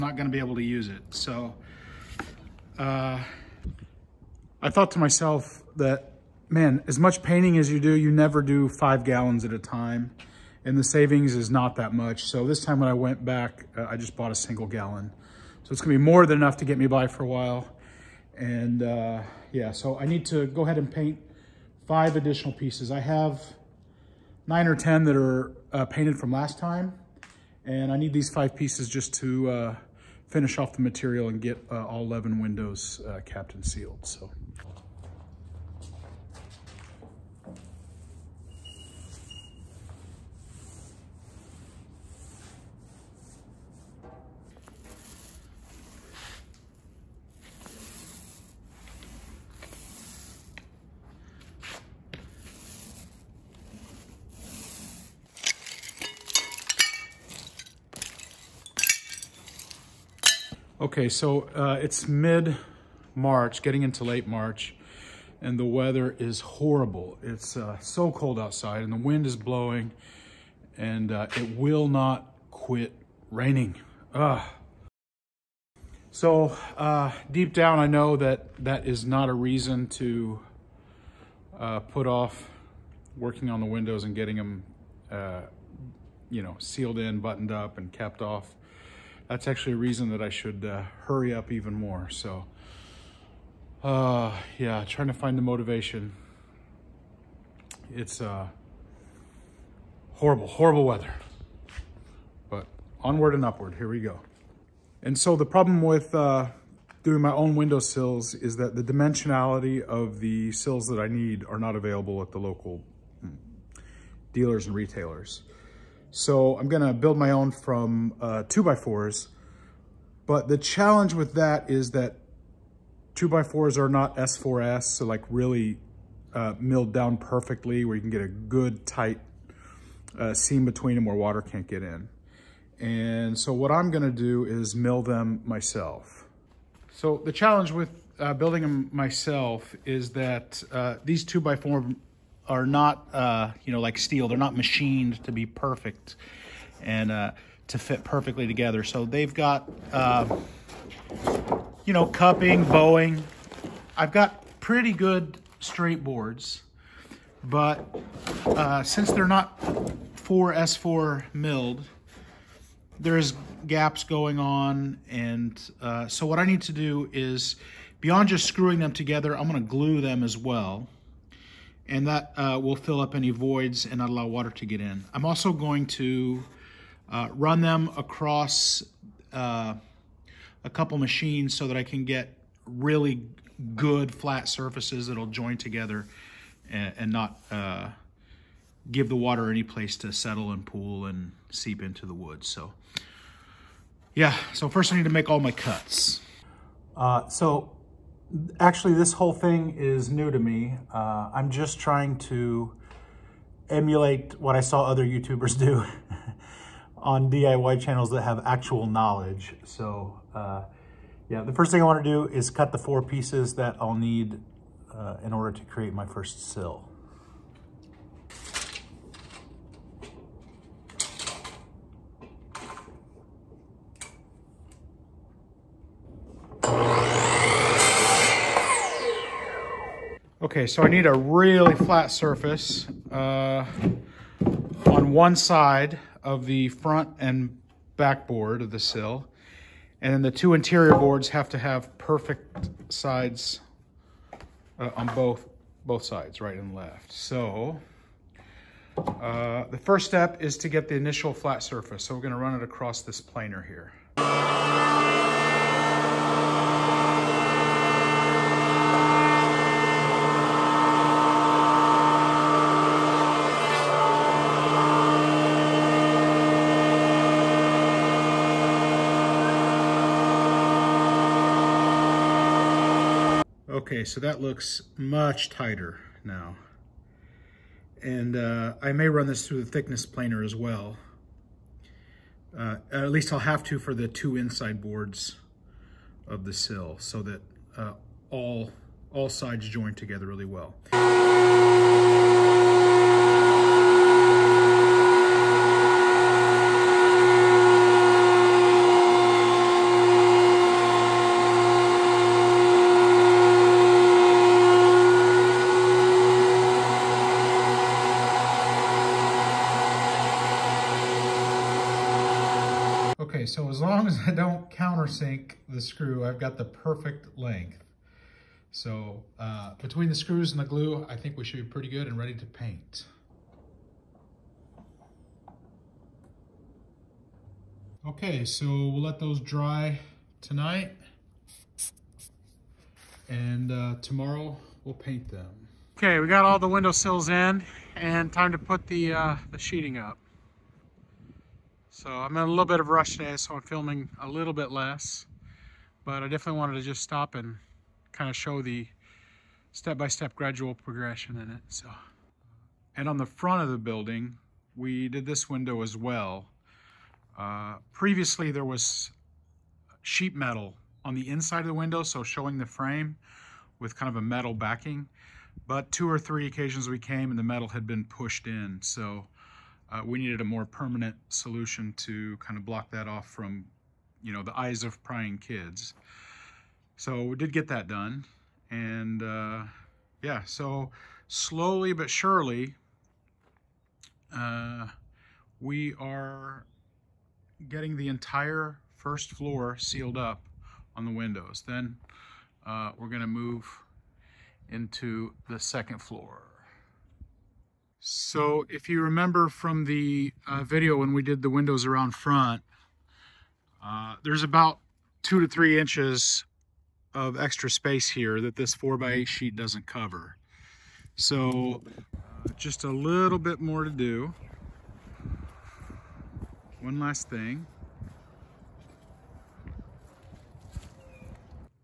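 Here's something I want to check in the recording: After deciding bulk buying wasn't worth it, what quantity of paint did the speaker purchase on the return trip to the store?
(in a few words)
a single gallon.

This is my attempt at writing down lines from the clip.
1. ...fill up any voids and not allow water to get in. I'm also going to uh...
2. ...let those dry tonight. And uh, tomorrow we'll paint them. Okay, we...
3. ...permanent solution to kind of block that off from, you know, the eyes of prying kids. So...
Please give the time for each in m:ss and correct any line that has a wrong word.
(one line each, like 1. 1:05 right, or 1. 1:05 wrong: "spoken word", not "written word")
1. 2:52 right
2. 5:29 right
3. 6:10 right.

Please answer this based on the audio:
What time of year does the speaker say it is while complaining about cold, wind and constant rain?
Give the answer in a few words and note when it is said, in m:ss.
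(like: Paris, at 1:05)
mid-March, at 1:02.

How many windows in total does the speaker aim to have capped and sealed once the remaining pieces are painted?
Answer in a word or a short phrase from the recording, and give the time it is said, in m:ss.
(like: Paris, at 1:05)
11, at 0:32.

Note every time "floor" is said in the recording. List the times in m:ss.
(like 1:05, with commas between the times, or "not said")
6:29, 6:36.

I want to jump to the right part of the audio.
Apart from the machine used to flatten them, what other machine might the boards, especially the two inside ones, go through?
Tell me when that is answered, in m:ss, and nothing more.
4:39.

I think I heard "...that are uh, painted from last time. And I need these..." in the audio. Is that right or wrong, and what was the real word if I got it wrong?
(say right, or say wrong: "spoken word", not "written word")
right.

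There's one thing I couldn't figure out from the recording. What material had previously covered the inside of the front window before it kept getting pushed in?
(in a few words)
sheet metal.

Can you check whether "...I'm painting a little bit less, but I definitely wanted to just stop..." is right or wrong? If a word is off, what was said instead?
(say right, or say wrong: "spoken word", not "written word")
wrong: "filming", not "painting".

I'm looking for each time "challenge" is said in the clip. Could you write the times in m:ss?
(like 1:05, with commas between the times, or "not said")
2:00, 2:17.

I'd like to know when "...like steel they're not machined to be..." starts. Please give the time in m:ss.
2:23.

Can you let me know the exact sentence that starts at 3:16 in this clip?
Uh, so actually, this whole thing is new to me.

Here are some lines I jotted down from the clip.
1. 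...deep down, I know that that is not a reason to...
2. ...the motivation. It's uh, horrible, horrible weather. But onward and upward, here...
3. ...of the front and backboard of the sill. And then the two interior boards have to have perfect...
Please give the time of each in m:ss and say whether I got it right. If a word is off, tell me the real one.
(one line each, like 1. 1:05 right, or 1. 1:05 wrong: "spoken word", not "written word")
1. 1:17 right
2. 1:35 right
3. 3:56 right.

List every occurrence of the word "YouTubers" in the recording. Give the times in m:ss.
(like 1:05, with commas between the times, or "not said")
3:25.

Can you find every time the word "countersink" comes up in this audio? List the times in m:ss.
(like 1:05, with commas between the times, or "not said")
5:14.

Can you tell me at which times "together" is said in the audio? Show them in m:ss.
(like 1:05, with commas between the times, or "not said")
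2:28, 2:48, 3:05, 4:49.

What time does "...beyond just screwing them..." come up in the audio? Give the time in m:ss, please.
2:48.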